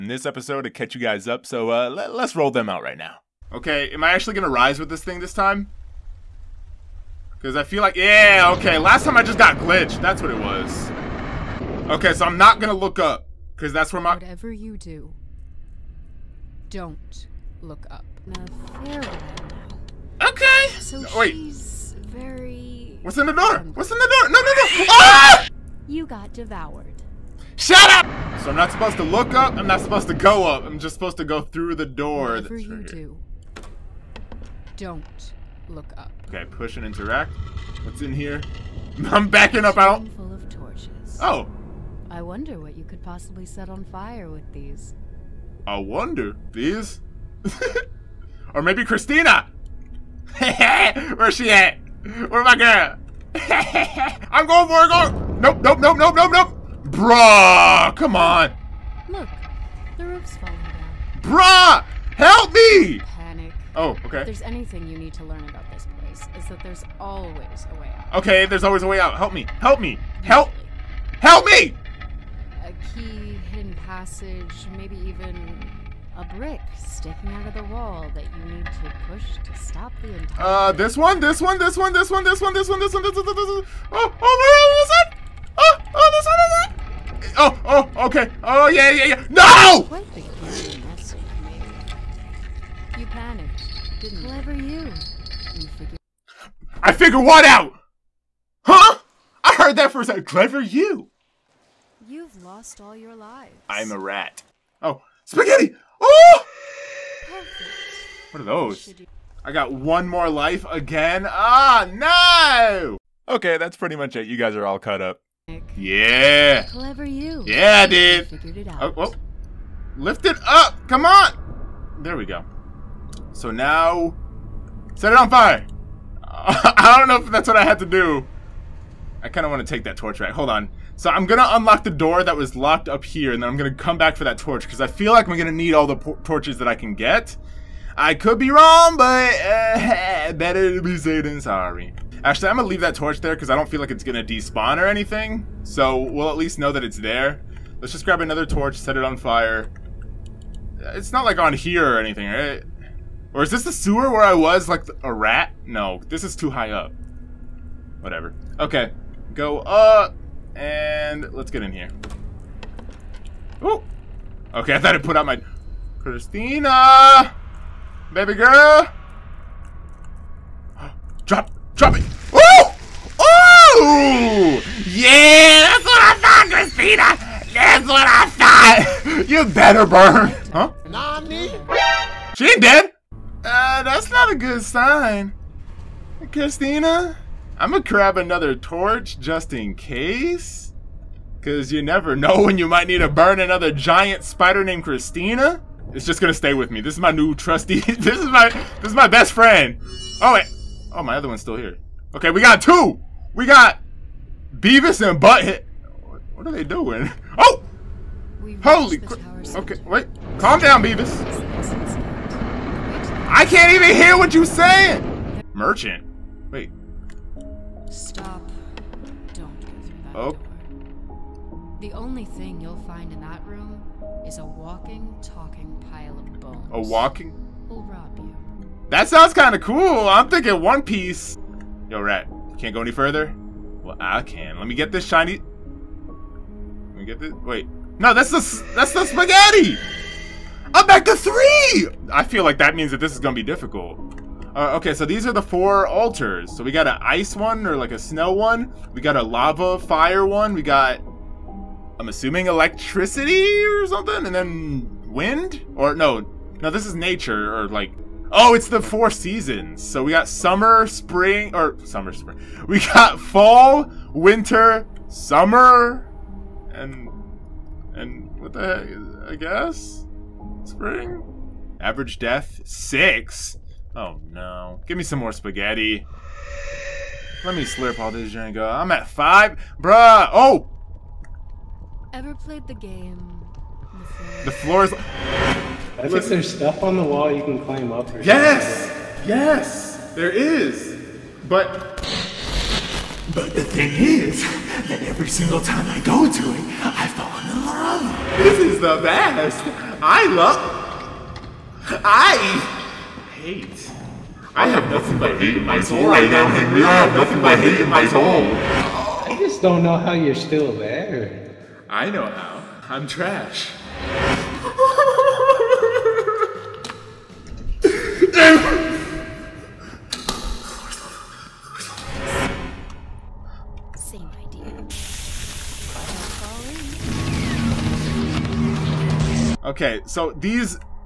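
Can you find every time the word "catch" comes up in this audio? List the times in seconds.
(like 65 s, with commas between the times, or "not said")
0 s.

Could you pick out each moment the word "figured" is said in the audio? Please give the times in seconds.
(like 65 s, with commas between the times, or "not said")
95 s, 118 s.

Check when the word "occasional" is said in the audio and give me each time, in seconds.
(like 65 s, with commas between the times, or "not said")
not said.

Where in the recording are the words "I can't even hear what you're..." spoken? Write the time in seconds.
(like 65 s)
213 s.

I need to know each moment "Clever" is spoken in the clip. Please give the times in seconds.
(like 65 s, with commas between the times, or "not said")
94 s, 100 s, 116 s.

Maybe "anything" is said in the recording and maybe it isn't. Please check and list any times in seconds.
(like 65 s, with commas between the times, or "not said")
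64 s, 144 s, 151 s.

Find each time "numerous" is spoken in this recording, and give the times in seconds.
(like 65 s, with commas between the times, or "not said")
not said.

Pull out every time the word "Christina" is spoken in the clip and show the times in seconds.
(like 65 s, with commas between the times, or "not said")
48 s, 165 s, 176 s, 186 s, 194 s.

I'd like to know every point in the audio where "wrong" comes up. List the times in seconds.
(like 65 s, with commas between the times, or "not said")
138 s.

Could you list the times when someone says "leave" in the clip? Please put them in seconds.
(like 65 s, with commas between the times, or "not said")
142 s.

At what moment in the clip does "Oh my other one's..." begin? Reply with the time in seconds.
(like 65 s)
200 s.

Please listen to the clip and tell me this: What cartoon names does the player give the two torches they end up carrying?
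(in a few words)
Beavis and Butthead.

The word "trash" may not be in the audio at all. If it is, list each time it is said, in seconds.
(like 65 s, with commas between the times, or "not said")
313 s.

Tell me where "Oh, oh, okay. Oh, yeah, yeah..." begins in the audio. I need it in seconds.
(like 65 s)
87 s.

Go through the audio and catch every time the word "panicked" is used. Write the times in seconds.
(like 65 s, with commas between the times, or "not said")
93 s.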